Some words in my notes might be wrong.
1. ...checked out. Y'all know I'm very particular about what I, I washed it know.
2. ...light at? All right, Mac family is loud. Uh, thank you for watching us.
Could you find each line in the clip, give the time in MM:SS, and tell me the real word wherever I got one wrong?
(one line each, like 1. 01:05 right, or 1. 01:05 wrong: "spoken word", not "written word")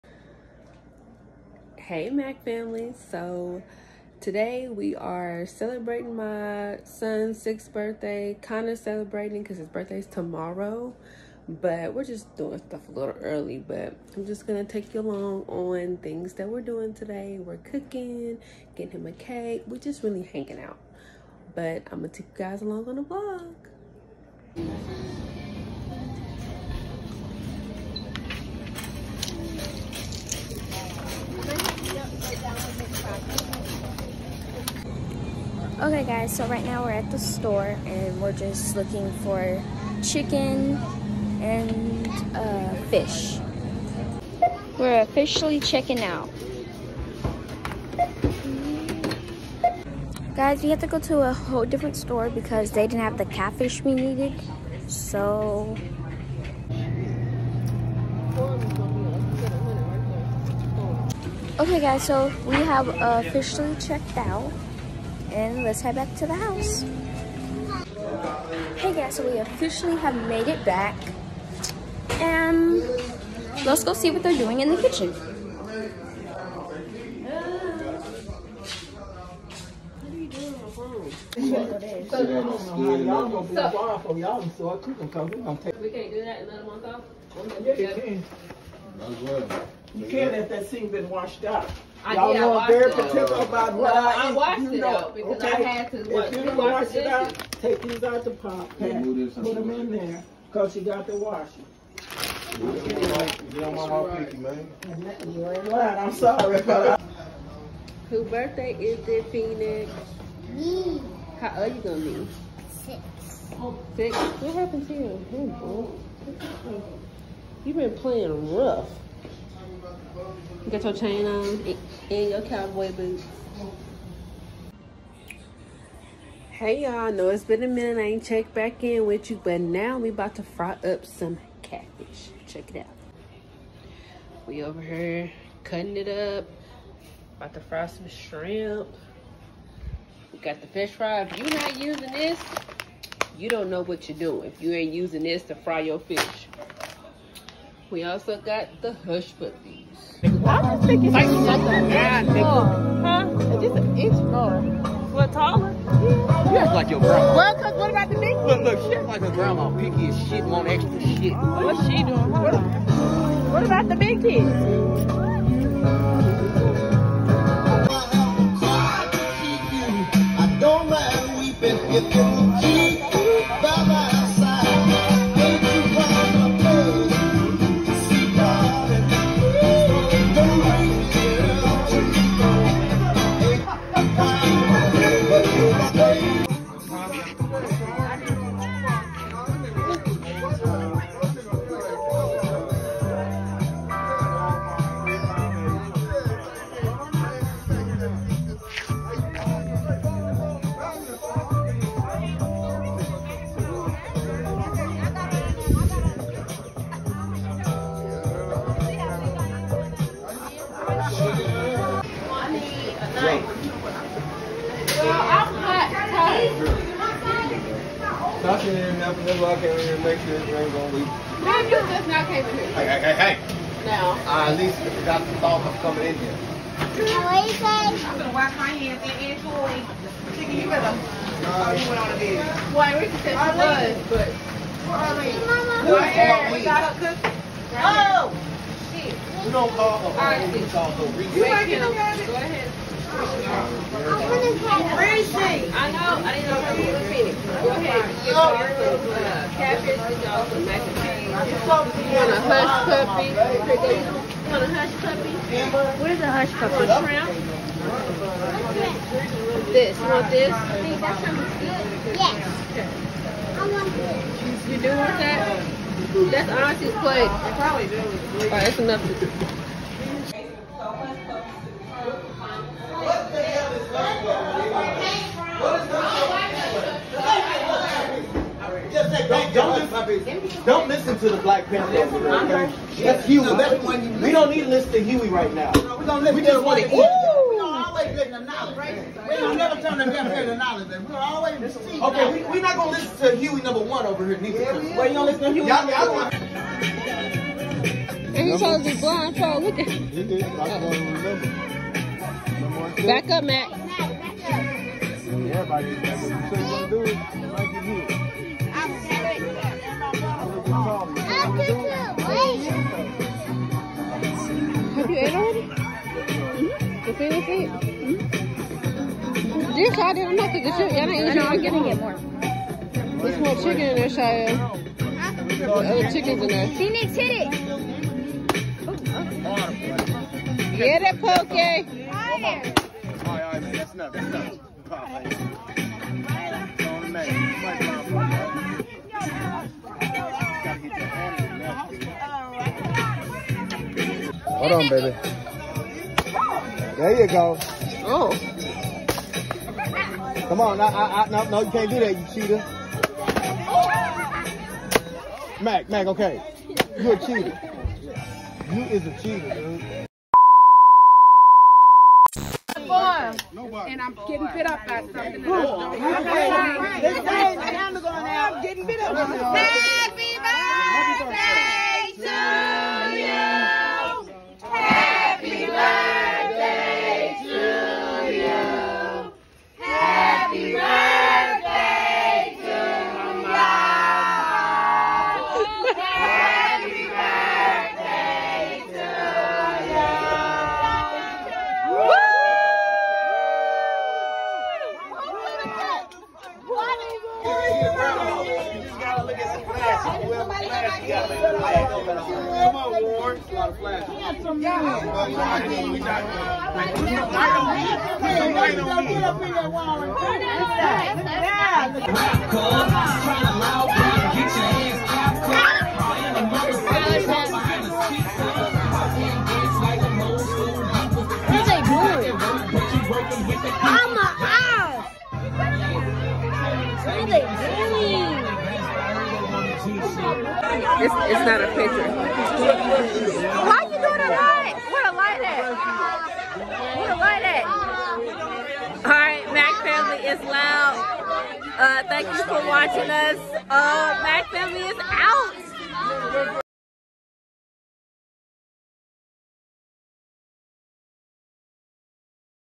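1. 01:31 wrong: "washed", not "checked"
2. 07:17 right.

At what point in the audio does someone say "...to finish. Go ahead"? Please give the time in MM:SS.
04:06.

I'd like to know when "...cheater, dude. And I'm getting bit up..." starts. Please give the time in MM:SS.
05:59.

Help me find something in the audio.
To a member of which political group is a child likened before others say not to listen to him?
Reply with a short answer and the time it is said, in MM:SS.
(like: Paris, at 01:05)
the Black Panther, at 04:41.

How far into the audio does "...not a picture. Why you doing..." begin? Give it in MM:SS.
07:11.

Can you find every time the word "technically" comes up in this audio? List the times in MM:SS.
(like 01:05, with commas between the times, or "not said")
not said.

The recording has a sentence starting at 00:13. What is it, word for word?
But I'm just gonna take you along on things that we're doing today.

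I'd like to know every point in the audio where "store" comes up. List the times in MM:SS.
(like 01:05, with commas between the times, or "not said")
00:37, 00:51.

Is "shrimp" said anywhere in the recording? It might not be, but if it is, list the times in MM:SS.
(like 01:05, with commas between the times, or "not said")
02:18, 04:17.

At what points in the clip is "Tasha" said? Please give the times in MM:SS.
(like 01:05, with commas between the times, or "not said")
03:38.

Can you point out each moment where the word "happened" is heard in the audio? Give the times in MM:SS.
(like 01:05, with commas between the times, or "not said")
01:54.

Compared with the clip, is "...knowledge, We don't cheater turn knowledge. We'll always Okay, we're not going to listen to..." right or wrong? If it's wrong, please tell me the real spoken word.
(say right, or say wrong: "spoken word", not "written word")
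wrong: "never", not "cheater".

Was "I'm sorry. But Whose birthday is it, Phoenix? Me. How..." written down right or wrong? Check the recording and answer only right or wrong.
right.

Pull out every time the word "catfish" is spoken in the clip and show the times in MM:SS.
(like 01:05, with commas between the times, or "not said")
00:53, 02:11.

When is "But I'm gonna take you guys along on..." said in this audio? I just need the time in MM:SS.
00:21.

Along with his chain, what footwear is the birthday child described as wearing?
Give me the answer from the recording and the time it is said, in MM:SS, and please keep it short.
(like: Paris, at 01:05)
cowboy boots, at 02:02.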